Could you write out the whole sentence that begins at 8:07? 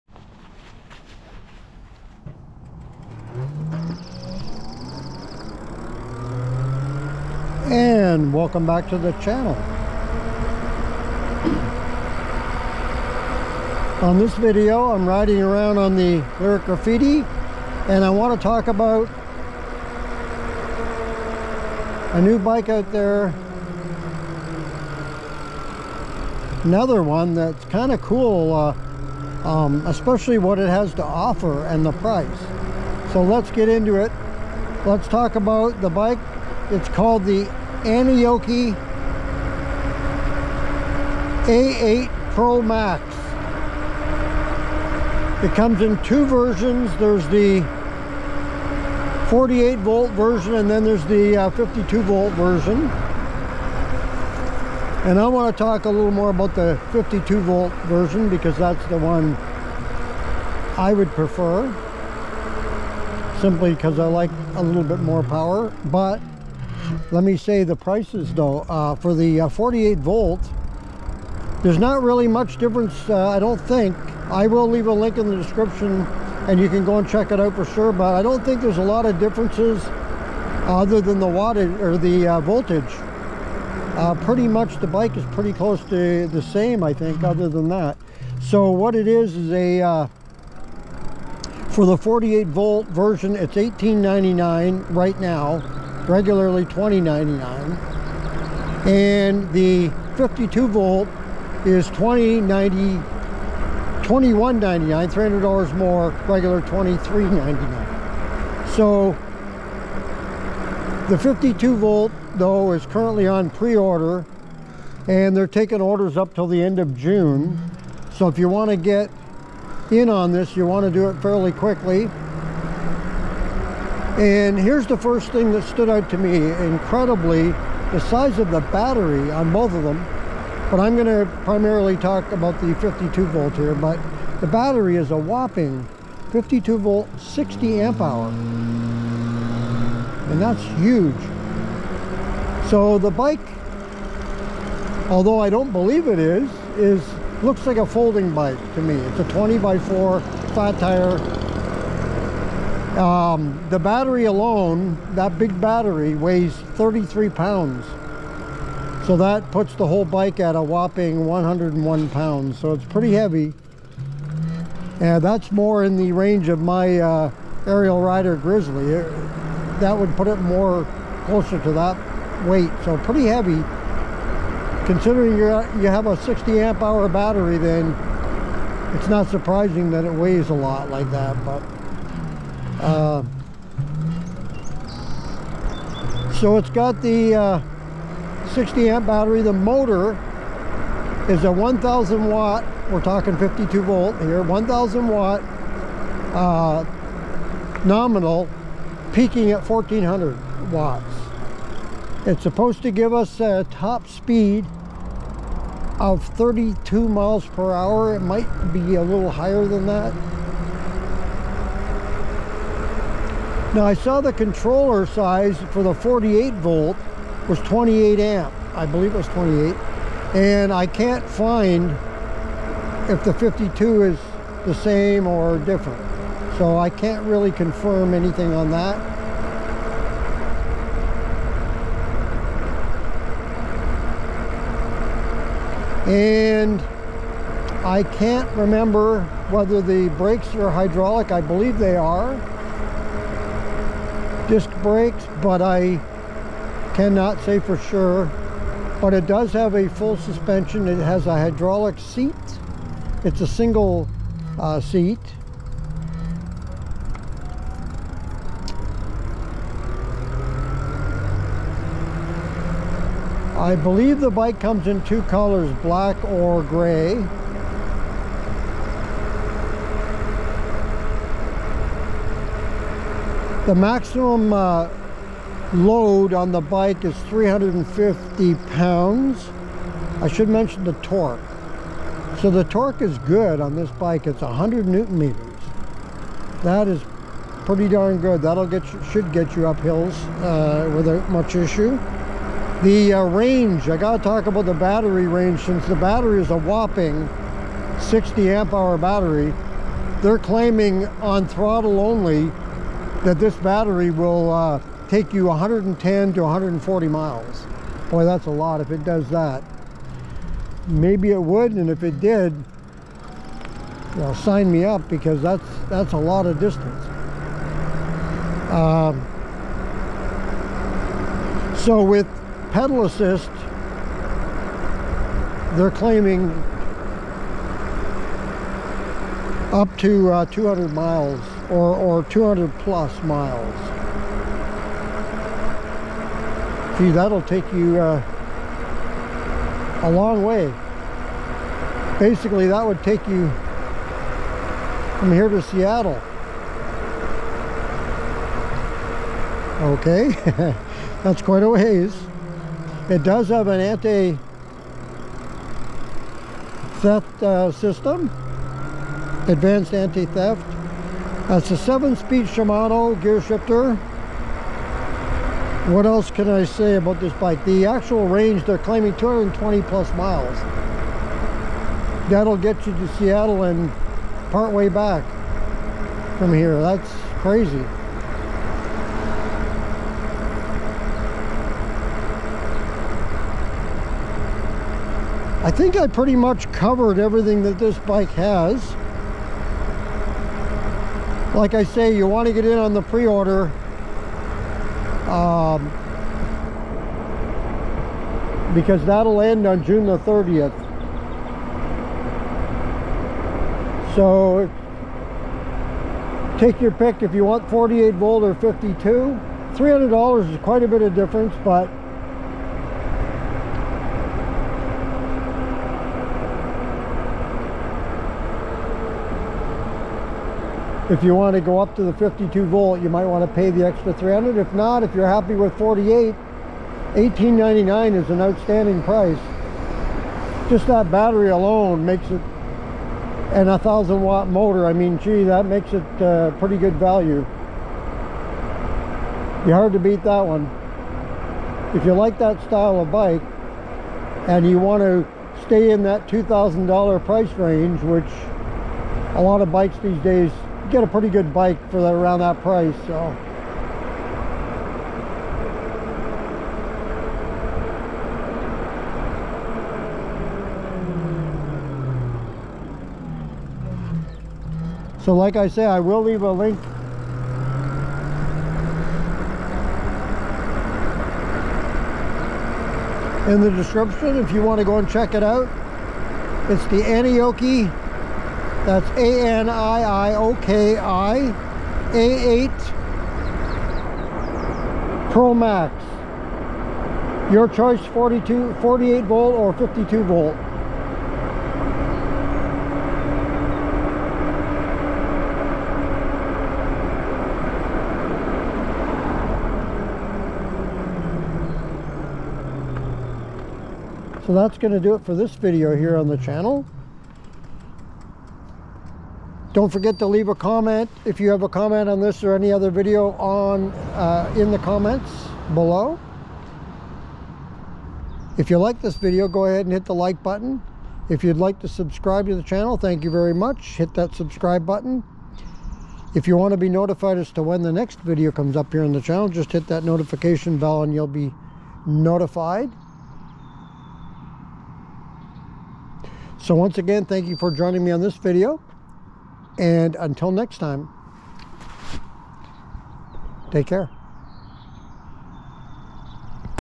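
Your choice 42, 48 volt or 52 volt.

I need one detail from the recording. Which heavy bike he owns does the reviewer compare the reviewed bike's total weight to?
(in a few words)
Ariel Rider Grizzly.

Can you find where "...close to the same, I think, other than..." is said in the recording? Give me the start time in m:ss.
1:25.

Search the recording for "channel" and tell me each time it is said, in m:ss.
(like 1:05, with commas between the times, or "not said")
0:09, 8:26, 8:42, 8:49.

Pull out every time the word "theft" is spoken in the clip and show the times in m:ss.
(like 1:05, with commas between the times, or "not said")
5:53, 5:59.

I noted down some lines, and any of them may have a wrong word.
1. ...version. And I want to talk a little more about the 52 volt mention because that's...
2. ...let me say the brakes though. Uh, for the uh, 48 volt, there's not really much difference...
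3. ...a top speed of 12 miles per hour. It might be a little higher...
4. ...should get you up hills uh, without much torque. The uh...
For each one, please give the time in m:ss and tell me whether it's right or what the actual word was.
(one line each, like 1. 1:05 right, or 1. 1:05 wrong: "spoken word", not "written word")
1. 0:52 wrong: "version", not "mention"
2. 1:07 wrong: "prices", not "brakes"
3. 3:23 wrong: "32", not "12"
4. 4:49 wrong: "issue", not "torque".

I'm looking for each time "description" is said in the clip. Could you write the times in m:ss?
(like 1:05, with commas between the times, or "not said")
1:15, 7:53.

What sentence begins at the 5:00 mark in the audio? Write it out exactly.
They're claiming on throttle only that this battery will uh, take you 110 to 140 miles.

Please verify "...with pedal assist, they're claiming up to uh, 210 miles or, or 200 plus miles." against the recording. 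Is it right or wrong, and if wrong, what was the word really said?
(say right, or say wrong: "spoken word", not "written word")
wrong: "200", not "210".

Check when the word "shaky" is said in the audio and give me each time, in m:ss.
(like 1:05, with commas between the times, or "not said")
not said.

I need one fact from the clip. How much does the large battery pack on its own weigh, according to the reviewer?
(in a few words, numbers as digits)
33 pounds.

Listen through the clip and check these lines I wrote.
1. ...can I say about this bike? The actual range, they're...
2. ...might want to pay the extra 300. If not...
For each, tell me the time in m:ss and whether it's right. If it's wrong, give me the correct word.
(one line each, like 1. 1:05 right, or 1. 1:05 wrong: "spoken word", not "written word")
1. 6:06 right
2. 7:03 right.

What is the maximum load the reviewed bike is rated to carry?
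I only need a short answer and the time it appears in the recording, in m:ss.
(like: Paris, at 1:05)
350 pounds, at 4:37.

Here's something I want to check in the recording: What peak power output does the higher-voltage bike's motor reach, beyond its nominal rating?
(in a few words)
1400 watts.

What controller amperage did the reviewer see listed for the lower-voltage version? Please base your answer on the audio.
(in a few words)
28 amp.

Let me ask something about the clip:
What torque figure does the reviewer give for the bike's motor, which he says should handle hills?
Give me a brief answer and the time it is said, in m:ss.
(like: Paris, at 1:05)
100 newton meters, at 4:44.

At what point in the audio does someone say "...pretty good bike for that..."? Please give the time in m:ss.
7:31.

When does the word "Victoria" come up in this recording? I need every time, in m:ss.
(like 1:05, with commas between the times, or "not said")
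not said.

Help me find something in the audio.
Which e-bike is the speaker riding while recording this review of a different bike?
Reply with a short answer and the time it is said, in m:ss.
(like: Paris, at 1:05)
Lyric Graffiti, at 0:16.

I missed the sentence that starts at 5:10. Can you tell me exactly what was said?
Maybe it would, and if it did, you know, sign me up because that's that's a lot of distance.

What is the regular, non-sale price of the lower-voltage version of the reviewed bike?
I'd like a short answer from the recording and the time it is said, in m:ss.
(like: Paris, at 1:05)
$2,099, at 1:36.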